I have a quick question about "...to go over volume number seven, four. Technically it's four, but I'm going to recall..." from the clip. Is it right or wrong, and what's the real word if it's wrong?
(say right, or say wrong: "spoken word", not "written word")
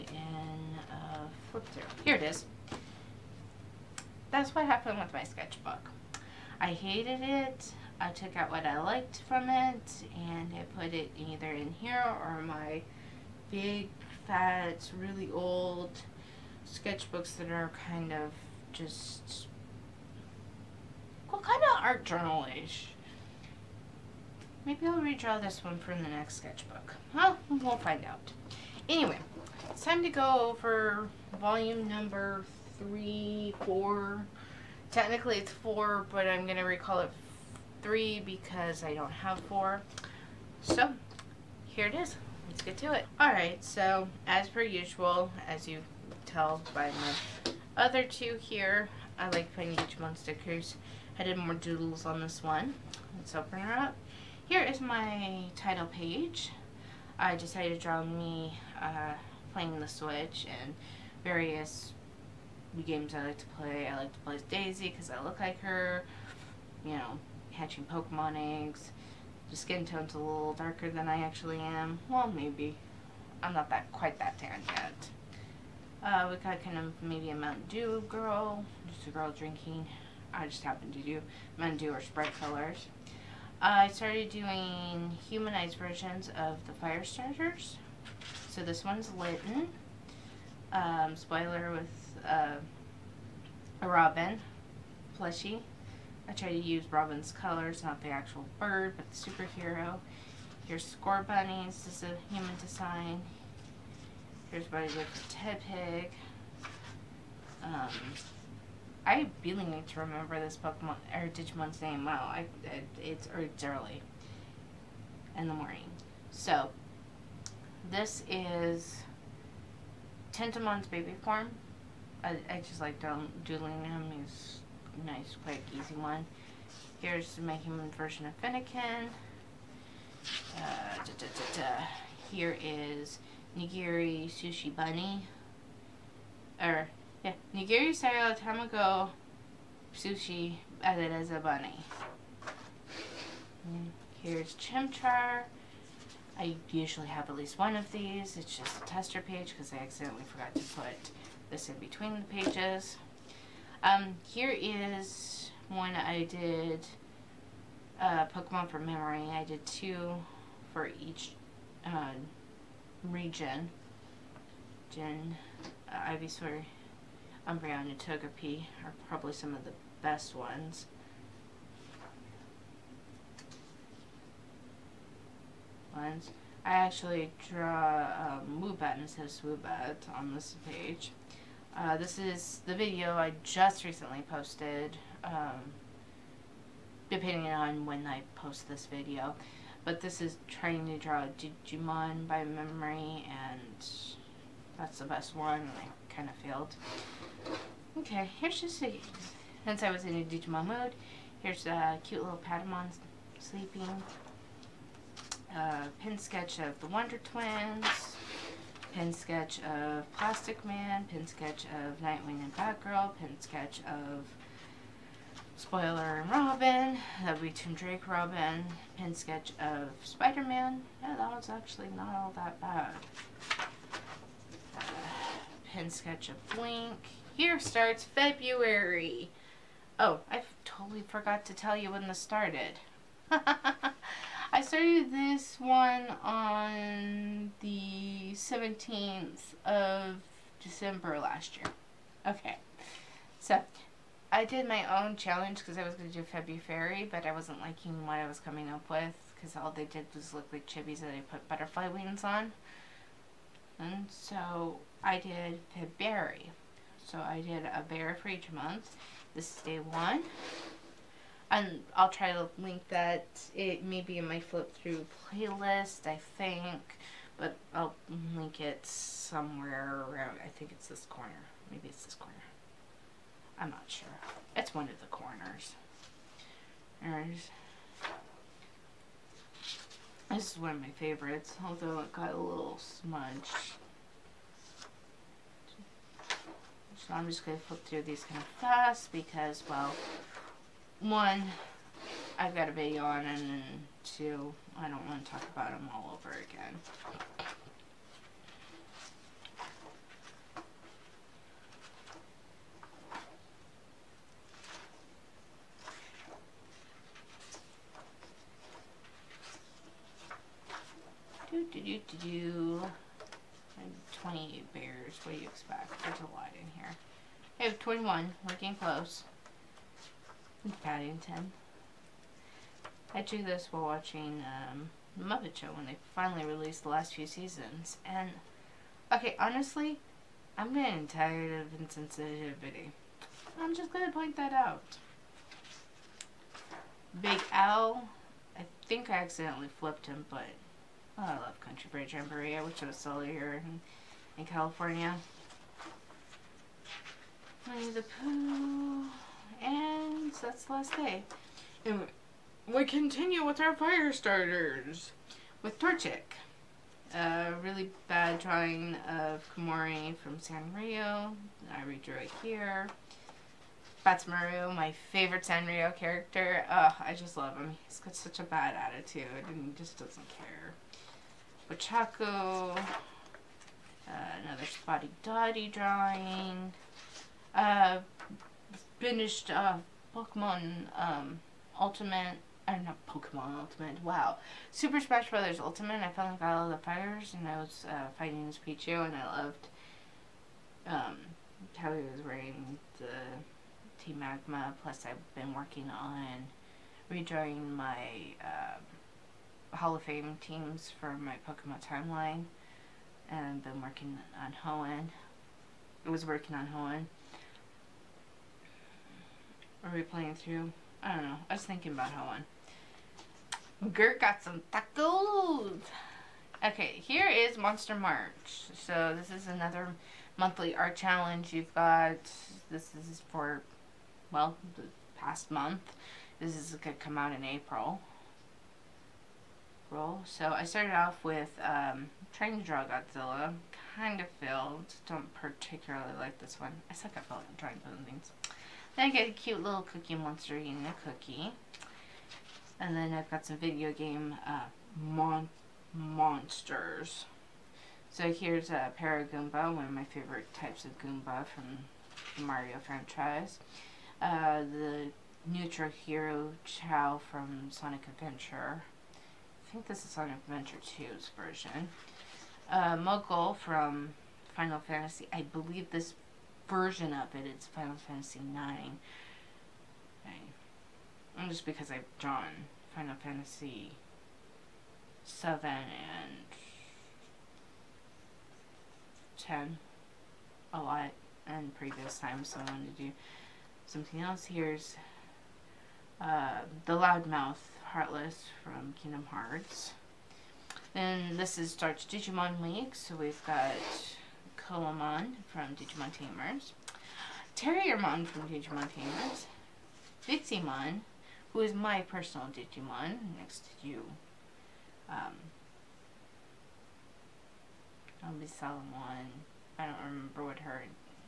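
wrong: "three", not "seven".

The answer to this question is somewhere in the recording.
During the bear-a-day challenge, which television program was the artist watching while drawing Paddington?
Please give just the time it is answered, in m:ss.
5:25.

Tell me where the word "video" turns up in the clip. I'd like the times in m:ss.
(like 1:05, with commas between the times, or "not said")
3:02, 3:08, 4:52, 7:23.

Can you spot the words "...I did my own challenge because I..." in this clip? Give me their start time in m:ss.
4:04.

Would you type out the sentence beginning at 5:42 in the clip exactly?
I wish it was still here in, in California.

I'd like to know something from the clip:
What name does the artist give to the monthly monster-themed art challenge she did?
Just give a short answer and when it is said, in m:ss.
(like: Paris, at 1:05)
Monster March, at 6:57.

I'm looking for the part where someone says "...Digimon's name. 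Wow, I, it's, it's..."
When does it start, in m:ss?
1:51.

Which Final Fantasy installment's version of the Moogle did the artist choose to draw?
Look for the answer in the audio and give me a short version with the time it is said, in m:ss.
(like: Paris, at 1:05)
Final Fantasy 9, at 7:47.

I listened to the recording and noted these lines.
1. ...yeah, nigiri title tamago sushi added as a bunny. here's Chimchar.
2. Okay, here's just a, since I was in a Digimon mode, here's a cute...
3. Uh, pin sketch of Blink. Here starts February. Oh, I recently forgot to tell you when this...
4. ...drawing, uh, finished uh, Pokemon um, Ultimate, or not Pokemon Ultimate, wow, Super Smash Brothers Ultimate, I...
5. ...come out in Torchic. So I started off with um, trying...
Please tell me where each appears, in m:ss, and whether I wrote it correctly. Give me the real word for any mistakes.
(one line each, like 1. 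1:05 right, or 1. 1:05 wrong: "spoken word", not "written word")
1. 2:17 wrong: "style", not "title"
2. 3:17 right
3. 3:44 wrong: "totally", not "recently"
4. 6:15 right
5. 7:07 wrong: "April", not "Torchic".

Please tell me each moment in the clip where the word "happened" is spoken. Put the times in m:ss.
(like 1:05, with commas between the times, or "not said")
0:04, 1:20.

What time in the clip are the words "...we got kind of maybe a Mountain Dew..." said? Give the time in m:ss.
1:16.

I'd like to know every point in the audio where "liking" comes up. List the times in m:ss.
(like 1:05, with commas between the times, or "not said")
4:07.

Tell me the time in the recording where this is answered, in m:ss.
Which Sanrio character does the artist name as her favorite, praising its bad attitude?
6:04.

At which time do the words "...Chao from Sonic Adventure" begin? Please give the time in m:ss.
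7:36.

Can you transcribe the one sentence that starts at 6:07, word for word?
He's got such a bad attitude and he just doesn't care.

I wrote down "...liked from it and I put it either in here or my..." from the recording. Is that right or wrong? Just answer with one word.
right.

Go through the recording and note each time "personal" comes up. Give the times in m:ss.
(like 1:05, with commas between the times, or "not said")
8:21.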